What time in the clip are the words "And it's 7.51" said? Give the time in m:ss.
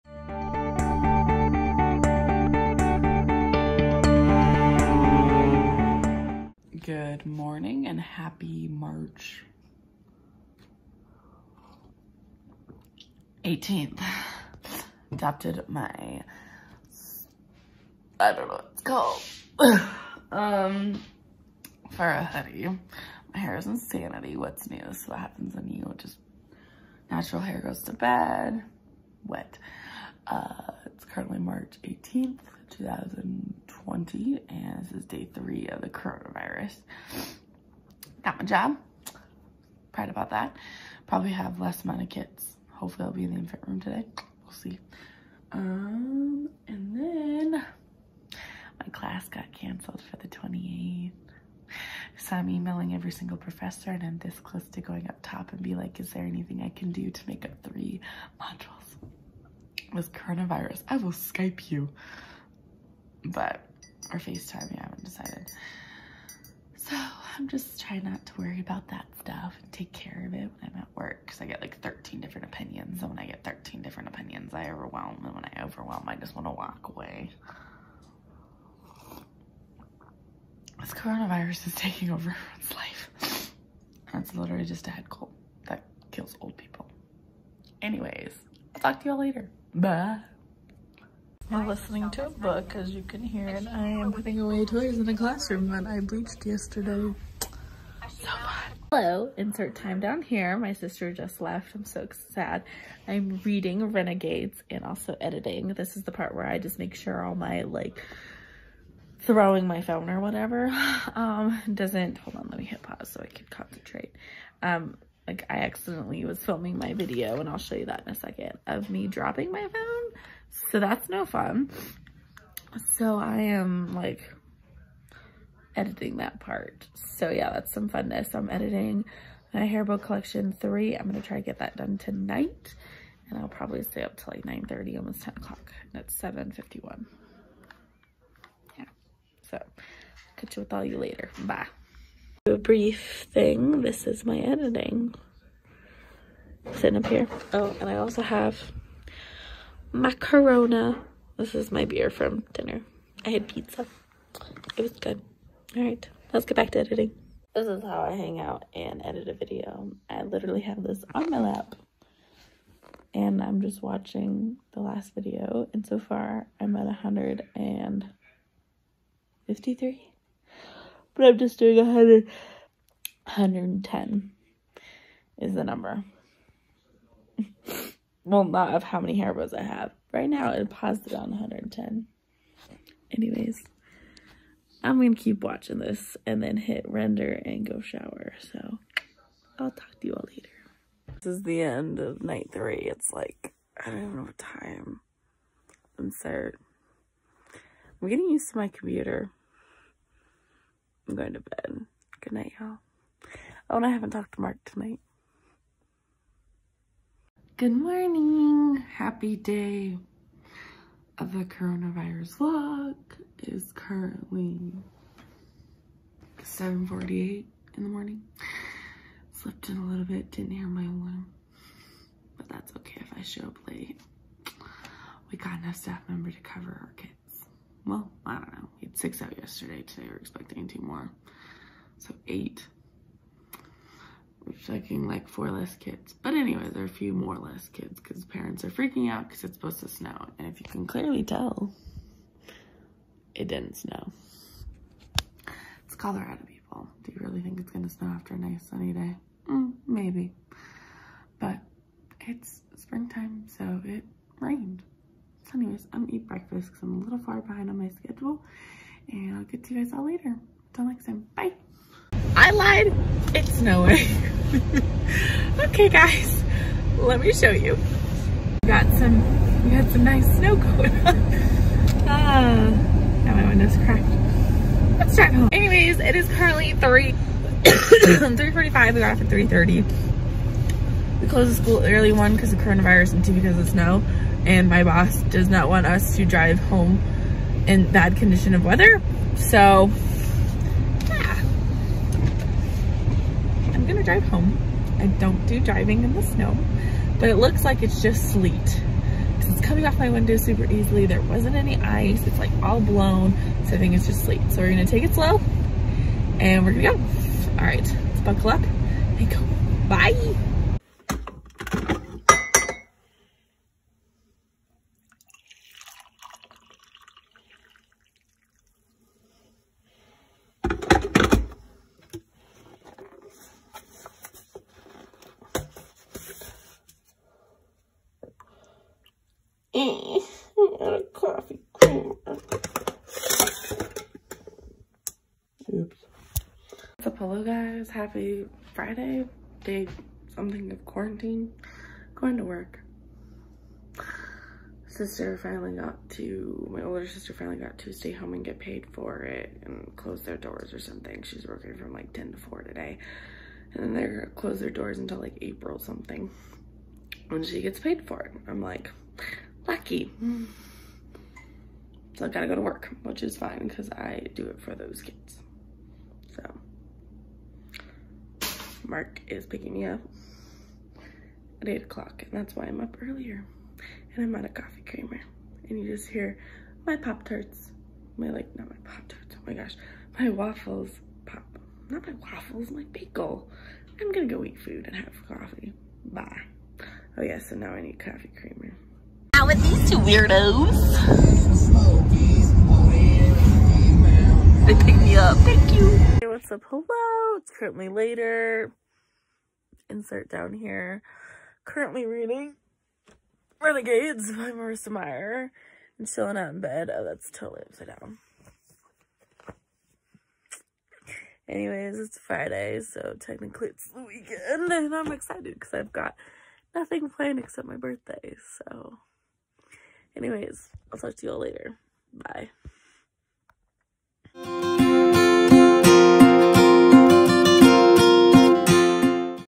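2:15.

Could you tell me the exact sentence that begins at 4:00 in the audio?
And if you can clearly tell, it didn't snow.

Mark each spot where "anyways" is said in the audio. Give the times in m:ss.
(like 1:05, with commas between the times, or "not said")
1:27, 3:03, 3:56, 4:15, 4:35, 6:51, 7:00.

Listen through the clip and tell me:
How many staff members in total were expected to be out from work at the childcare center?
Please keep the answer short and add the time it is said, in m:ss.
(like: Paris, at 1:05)
8, at 3:51.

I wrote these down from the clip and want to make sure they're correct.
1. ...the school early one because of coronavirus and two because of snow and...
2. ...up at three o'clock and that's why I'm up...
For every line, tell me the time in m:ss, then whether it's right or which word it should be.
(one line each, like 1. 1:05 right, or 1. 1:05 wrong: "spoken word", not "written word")
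1. 4:41 right
2. 6:09 wrong: "eight", not "three".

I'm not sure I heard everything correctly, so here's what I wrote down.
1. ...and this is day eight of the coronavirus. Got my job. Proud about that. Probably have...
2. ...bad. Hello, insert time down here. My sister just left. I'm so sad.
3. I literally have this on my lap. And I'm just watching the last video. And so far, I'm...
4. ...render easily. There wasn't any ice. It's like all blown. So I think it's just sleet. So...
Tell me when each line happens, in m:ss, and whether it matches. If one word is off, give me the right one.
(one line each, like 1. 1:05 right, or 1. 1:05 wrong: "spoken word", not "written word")
1. 0:34 wrong: "three", not "eight"
2. 1:38 right
3. 2:40 right
4. 5:00 wrong: "super", not "render".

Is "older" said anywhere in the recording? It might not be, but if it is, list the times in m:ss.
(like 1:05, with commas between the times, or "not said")
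5:46.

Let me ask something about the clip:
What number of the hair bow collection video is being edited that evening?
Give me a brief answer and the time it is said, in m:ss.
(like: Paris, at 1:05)
3, at 2:09.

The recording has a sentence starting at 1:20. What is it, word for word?
This coronavirus is taking over everyone's life.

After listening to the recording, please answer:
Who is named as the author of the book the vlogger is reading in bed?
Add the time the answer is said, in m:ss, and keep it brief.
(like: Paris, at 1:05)
Marissa Meyer, at 6:44.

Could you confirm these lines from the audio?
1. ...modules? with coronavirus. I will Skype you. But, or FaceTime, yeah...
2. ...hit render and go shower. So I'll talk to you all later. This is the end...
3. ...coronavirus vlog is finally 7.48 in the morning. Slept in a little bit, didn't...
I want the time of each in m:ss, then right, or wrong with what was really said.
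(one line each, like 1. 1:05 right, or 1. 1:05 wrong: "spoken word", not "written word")
1. 0:58 right
2. 3:06 right
3. 3:31 wrong: "currently", not "finally".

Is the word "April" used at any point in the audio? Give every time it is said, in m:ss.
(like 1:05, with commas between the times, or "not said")
5:55.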